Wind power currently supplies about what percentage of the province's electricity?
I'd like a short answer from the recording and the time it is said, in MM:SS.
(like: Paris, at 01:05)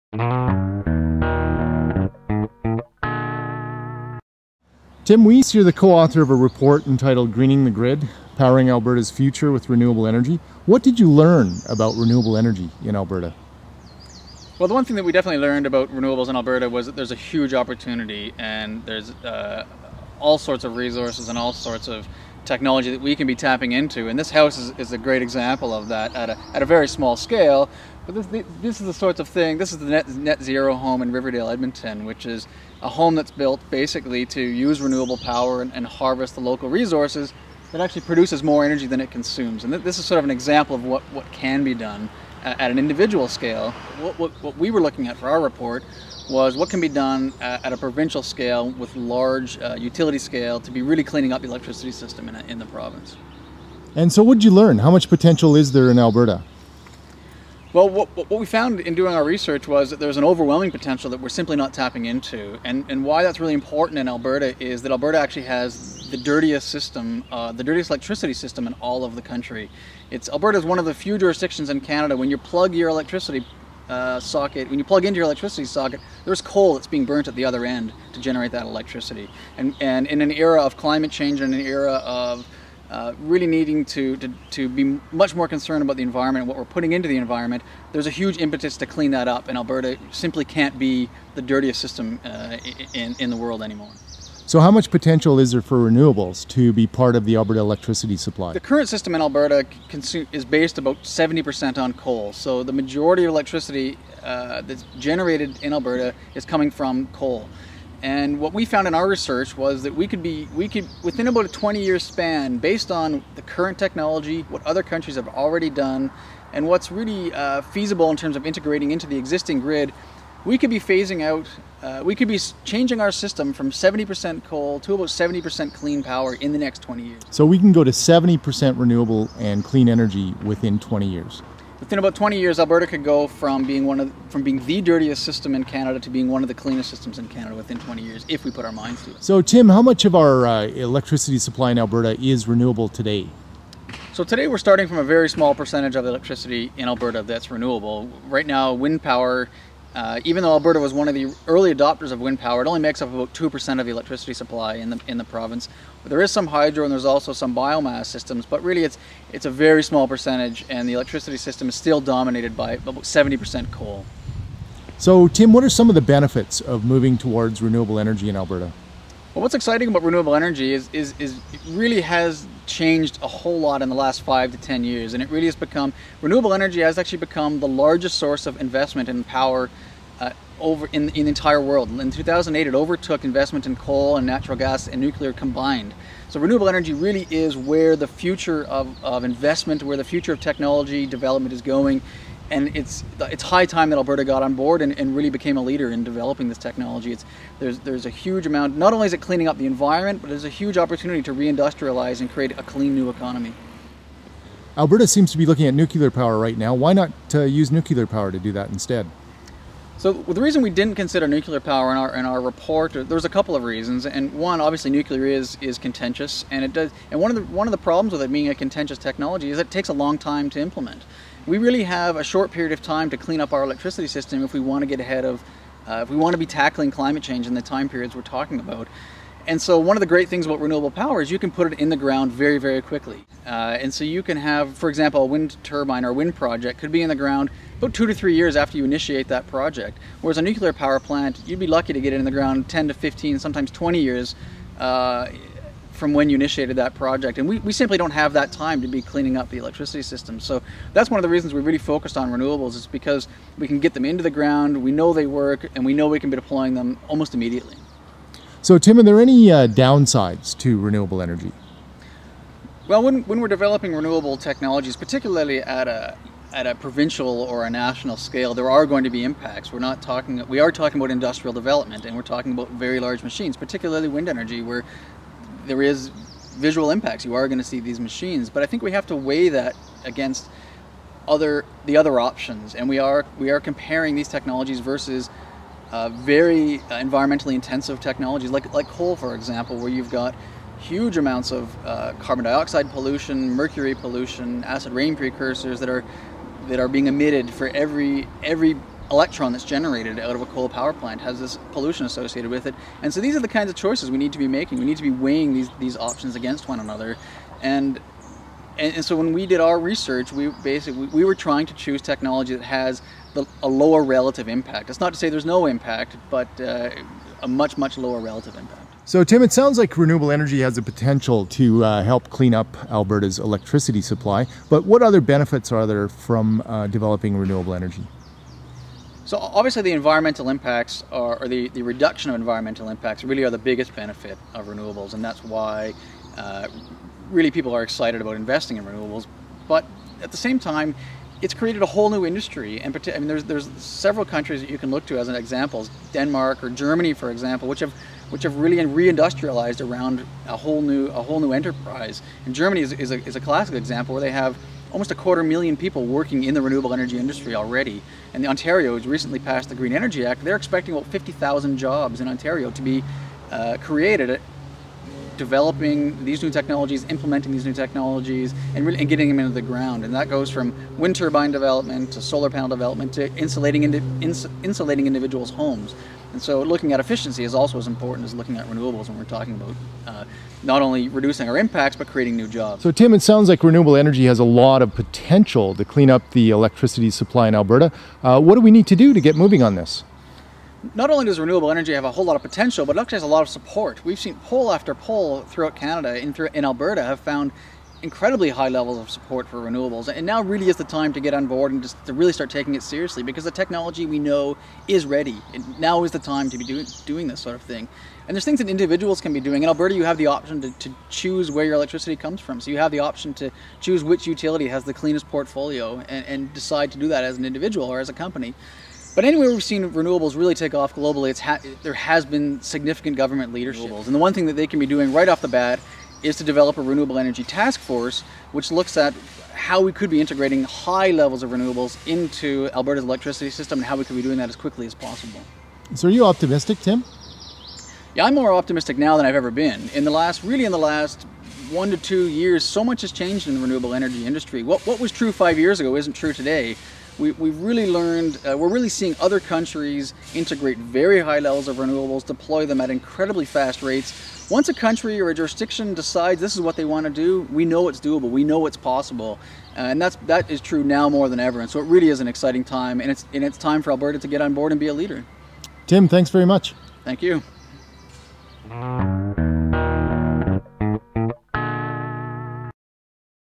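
2%, at 02:33.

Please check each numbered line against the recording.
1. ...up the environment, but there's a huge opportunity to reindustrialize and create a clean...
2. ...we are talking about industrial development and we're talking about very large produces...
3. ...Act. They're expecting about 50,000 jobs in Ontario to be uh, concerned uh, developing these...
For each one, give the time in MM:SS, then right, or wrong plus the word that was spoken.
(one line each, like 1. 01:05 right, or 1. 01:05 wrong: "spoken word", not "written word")
1. 03:19 right
2. 04:30 wrong: "machines", not "produces"
3. 06:00 wrong: "created", not "concerned".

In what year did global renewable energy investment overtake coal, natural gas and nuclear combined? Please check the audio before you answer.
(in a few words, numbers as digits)
2008.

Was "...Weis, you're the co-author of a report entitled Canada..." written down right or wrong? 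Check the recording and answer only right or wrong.
wrong.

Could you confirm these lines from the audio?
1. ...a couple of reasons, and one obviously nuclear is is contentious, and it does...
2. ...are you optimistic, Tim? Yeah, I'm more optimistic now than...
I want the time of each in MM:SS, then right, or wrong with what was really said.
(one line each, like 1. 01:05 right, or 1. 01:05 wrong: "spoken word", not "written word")
1. 03:33 right
2. 07:16 right.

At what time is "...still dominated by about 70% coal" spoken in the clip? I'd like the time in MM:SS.
02:41.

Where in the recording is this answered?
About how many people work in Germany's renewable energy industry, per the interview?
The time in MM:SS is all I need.
05:54.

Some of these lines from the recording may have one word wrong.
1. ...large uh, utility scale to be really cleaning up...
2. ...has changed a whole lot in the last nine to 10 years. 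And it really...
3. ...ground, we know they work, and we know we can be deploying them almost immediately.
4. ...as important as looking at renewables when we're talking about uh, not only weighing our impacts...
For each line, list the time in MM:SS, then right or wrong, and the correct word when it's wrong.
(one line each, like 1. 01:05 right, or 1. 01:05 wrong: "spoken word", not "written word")
1. 00:48 right
2. 02:52 wrong: "five", not "nine"
3. 04:14 right
4. 06:17 wrong: "reducing", not "weighing".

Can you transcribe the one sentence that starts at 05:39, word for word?
But at the same time, it's created a whole new industry.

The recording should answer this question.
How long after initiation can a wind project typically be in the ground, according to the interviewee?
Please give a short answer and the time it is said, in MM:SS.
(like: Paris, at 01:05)
2 to 3 years, at 03:57.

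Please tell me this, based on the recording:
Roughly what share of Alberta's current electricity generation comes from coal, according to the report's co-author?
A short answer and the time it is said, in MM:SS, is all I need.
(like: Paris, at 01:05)
70%, at 01:41.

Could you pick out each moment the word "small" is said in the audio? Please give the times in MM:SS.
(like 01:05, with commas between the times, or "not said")
00:26, 02:25, 02:39.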